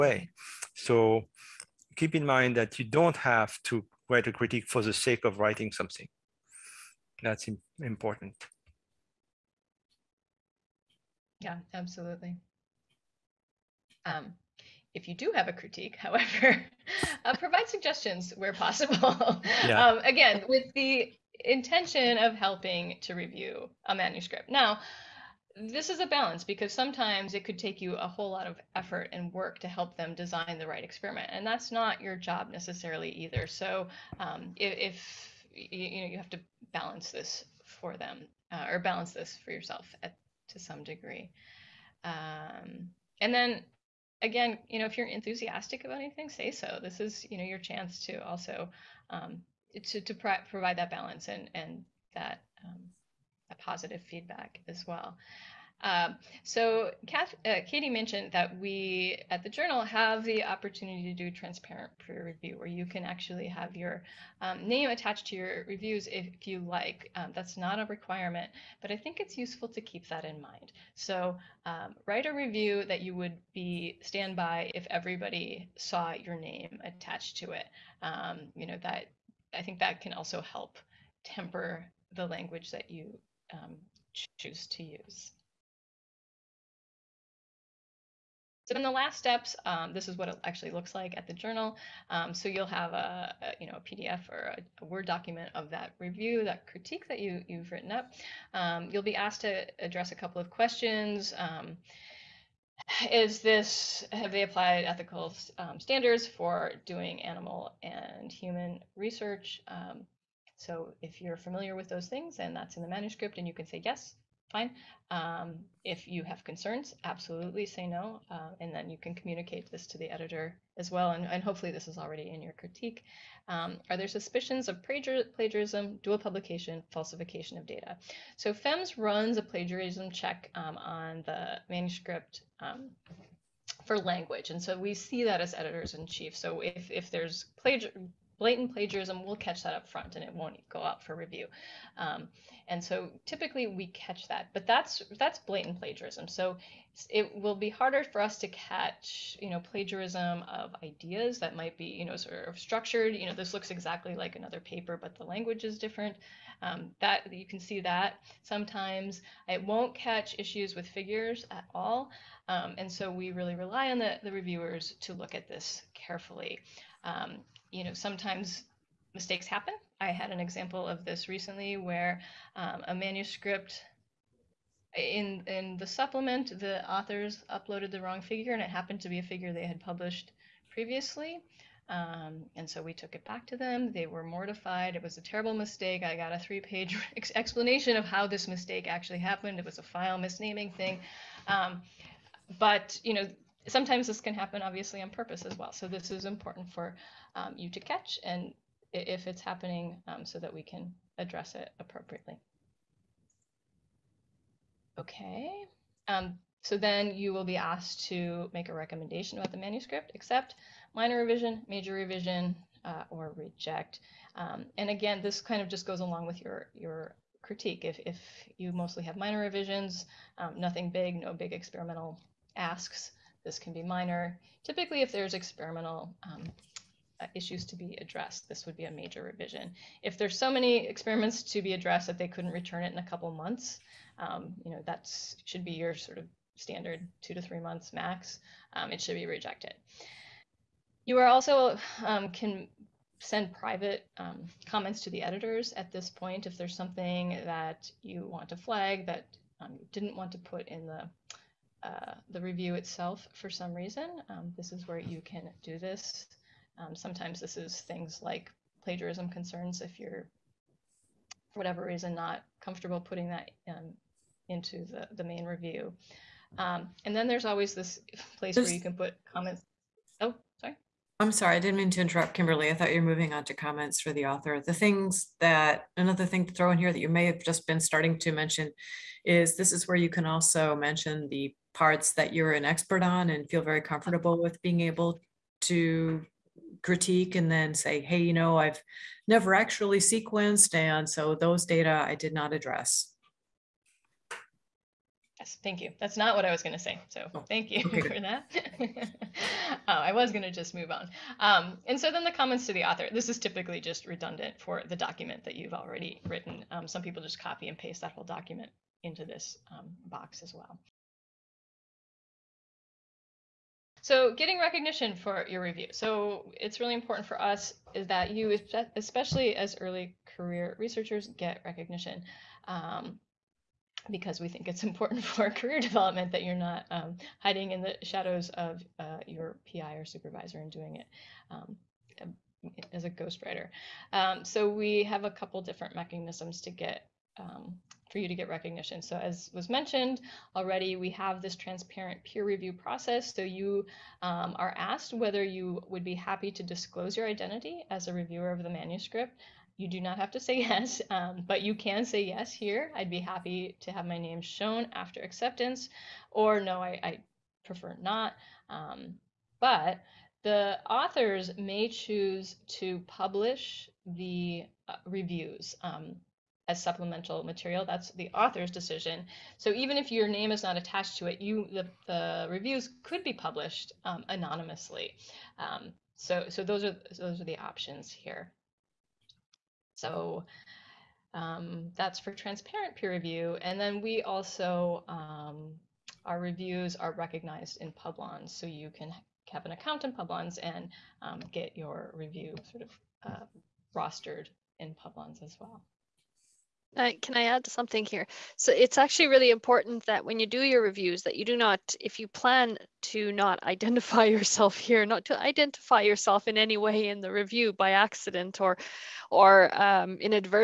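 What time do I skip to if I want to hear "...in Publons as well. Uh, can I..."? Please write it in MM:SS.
06:34.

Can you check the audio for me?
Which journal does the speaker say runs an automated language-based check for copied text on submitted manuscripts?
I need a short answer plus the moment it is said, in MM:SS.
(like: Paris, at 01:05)
FEMS, at 02:08.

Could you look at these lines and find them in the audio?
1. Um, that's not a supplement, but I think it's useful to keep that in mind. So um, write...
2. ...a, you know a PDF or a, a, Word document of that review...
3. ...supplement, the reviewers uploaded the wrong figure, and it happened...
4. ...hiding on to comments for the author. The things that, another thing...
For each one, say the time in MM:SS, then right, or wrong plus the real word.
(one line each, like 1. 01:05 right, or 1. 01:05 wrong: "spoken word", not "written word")
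1. 01:07 wrong: "requirement", not "supplement"
2. 01:33 right
3. 02:55 wrong: "authors", not "reviewers"
4. 04:33 wrong: "moving", not "hiding".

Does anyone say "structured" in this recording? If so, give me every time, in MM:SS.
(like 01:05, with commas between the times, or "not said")
02:32.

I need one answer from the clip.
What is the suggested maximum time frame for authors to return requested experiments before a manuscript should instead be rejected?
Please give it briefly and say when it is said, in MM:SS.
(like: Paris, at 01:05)
2 to 3 months, at 03:57.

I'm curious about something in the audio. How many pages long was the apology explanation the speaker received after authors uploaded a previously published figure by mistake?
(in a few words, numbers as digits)
3.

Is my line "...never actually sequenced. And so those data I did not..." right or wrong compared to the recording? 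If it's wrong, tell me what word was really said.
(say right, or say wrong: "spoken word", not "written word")
right.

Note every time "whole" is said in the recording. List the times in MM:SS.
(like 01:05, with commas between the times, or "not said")
00:28, 05:08.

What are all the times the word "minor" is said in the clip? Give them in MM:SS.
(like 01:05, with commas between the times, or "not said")
03:30, 03:39, 03:43.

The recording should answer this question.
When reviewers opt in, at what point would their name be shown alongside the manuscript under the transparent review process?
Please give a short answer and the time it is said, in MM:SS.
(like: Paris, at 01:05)
after acceptance, at 05:54.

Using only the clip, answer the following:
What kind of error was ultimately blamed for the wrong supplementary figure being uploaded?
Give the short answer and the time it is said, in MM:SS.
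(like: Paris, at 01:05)
file misnaming, at 03:09.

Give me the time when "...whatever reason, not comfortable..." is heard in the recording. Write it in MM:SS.
04:21.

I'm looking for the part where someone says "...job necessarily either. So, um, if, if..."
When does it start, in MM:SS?
00:32.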